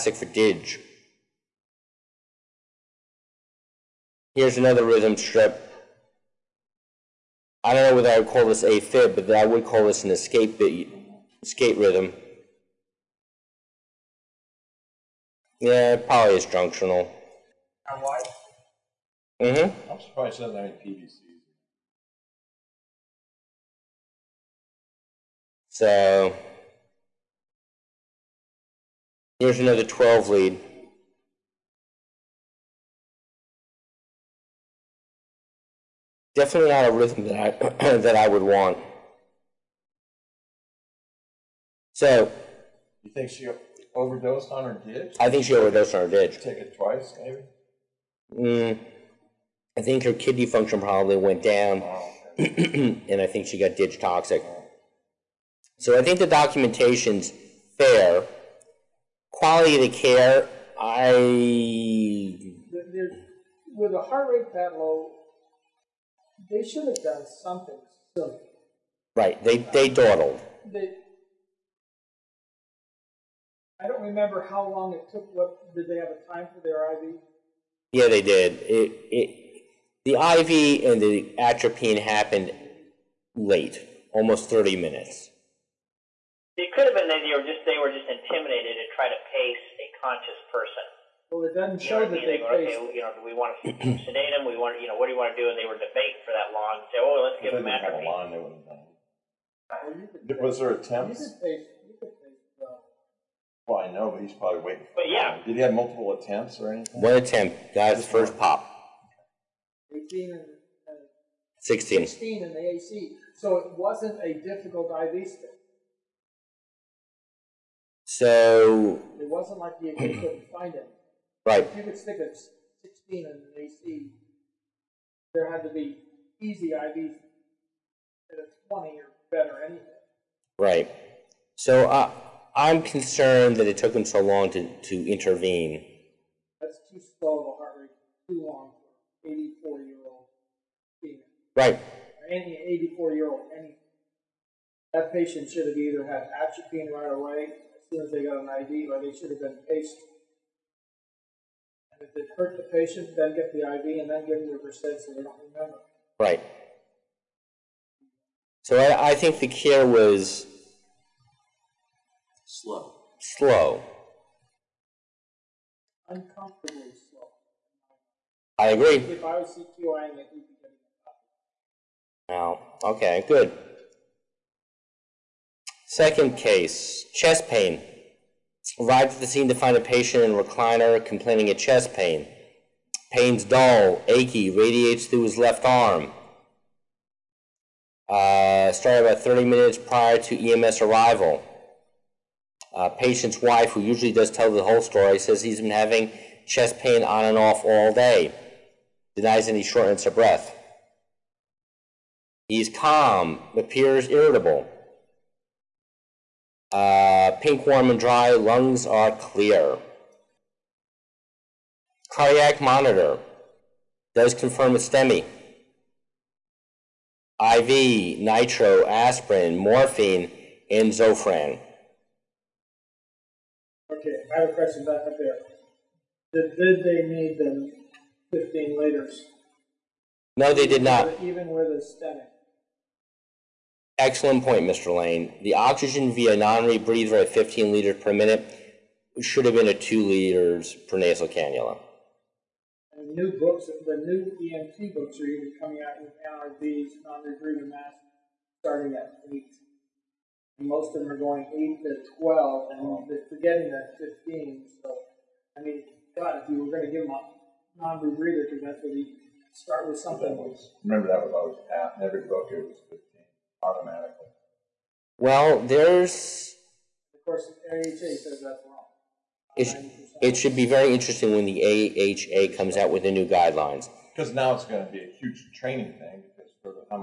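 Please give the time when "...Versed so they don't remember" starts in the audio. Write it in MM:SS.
02:34.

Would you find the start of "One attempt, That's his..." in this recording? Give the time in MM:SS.
01:47.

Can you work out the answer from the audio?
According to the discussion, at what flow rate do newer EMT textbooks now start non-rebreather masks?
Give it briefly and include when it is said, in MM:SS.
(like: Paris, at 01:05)
8, at 04:08.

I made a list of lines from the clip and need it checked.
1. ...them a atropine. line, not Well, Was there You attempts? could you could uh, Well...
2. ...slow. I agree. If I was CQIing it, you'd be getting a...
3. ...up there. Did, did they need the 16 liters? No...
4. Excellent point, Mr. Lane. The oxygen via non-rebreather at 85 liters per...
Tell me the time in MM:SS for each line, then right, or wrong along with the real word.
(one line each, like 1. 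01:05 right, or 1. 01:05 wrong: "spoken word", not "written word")
1. 01:37 right
2. 02:47 right
3. 03:45 wrong: "15", not "16"
4. 03:53 wrong: "15", not "85".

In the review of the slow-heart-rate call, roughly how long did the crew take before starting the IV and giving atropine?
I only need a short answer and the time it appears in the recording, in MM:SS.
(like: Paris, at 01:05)
almost 30 minutes, at 01:24.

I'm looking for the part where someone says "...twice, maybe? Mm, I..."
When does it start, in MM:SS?
00:46.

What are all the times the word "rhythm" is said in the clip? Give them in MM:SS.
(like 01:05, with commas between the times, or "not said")
00:04, 00:11, 00:36.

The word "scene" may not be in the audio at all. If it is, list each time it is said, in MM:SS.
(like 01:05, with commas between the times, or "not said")
02:59.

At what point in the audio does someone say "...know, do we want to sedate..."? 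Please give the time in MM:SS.
01:33.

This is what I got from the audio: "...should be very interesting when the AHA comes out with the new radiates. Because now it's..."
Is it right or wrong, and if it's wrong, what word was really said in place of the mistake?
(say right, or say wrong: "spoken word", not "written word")
wrong: "guidelines", not "radiates".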